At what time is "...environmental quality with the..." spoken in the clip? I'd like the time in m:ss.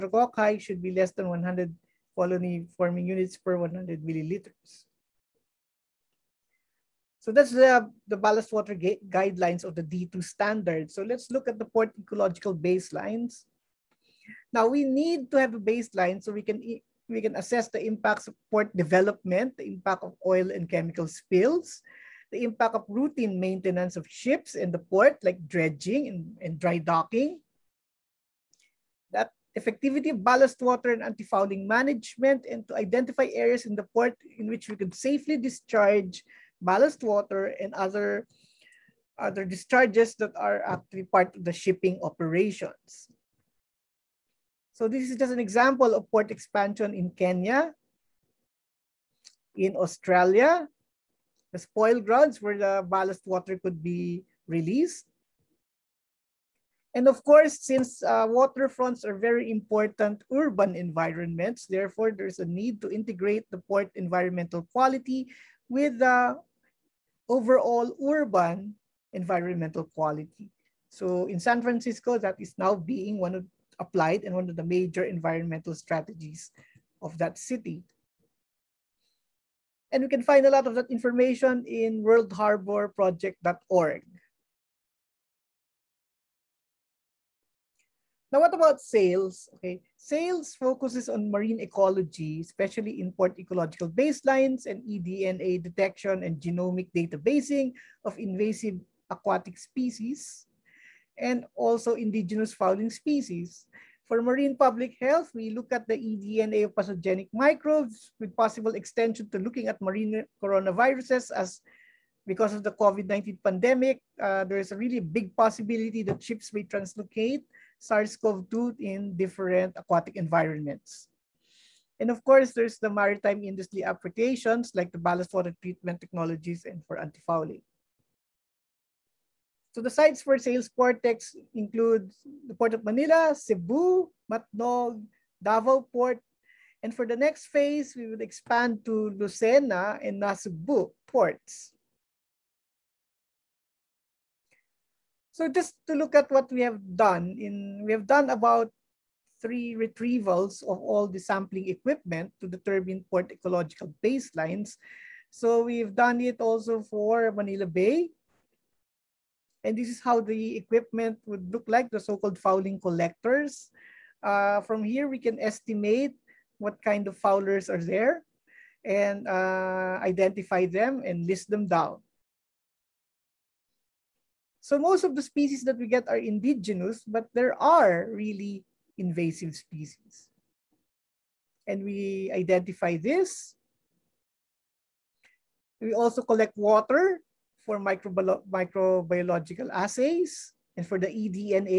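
1:03.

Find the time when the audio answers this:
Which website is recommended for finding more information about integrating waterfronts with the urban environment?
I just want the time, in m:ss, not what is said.
1:22.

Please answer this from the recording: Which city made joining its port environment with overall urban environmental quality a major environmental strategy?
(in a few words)
San Francisco.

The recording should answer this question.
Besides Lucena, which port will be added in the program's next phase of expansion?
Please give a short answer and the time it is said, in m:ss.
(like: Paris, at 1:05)
Nasugbu, at 2:20.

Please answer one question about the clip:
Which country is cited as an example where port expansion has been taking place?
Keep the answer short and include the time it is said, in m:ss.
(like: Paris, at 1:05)
Kenya, at 0:47.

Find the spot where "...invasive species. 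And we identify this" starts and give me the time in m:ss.
2:58.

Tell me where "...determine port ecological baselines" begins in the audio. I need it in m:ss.
2:32.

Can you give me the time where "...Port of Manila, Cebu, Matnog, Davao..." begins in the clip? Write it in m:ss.
2:12.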